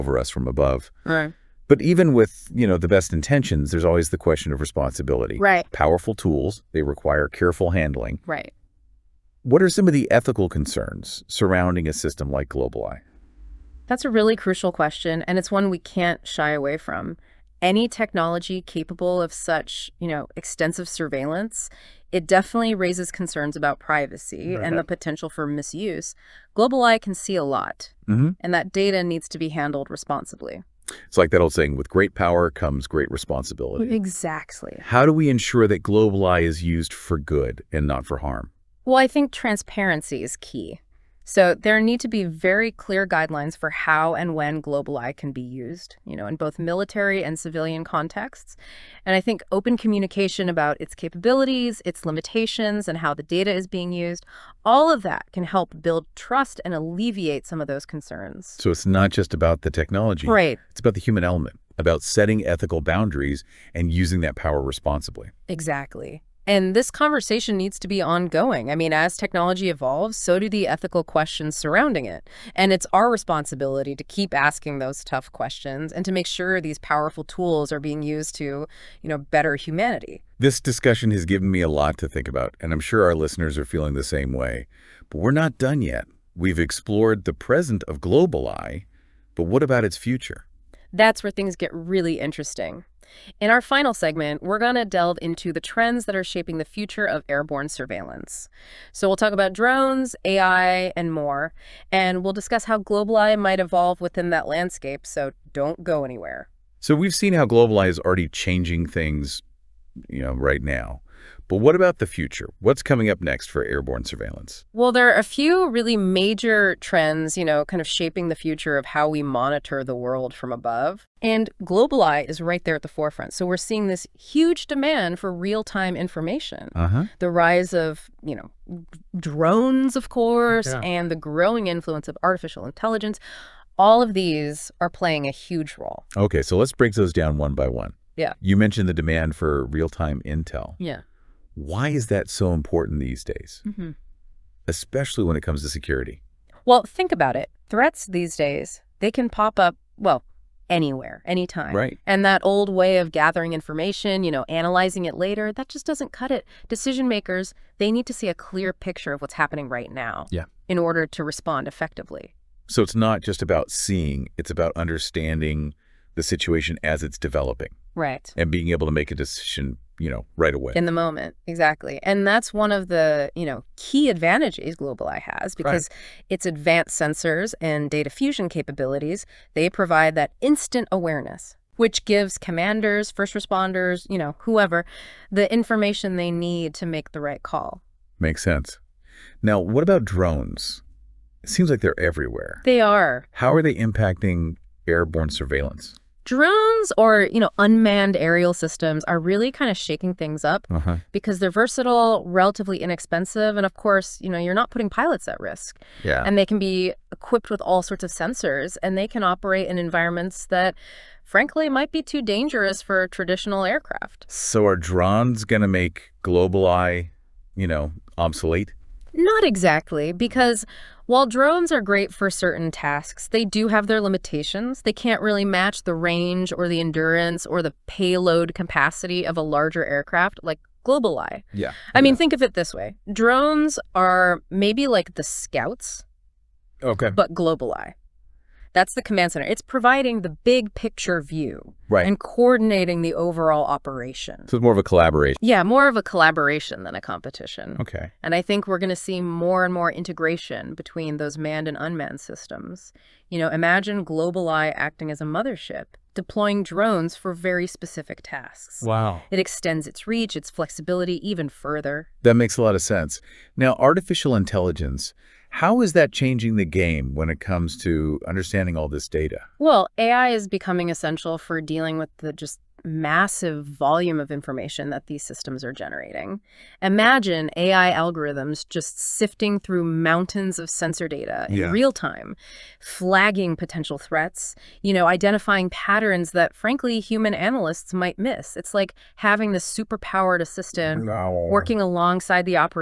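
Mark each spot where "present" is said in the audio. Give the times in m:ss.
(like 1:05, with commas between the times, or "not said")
1:27.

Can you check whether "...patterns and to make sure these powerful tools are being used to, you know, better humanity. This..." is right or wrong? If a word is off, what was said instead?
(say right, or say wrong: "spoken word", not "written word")
wrong: "questions", not "patterns".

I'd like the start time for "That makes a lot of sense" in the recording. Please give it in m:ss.
4:22.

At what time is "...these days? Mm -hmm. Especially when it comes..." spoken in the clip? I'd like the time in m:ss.
2:23.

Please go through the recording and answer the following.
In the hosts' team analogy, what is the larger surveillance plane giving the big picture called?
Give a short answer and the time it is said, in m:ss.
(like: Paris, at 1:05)
The command center, at 3:58.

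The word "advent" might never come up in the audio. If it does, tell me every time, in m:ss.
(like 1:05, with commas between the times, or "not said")
not said.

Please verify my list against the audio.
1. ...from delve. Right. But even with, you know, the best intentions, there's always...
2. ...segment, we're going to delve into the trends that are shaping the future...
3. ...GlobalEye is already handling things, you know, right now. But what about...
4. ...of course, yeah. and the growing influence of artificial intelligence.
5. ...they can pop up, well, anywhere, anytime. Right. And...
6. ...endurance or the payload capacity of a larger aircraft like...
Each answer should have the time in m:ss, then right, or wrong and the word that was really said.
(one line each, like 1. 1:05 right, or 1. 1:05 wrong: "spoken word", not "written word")
1. 0:00 wrong: "above", not "delve"
2. 1:33 right
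3. 1:47 wrong: "changing", not "handling"
4. 2:09 right
5. 2:28 right
6. 3:46 right.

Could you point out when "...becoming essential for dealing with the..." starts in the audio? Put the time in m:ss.
4:30.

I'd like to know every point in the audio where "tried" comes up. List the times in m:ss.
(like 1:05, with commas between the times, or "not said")
not said.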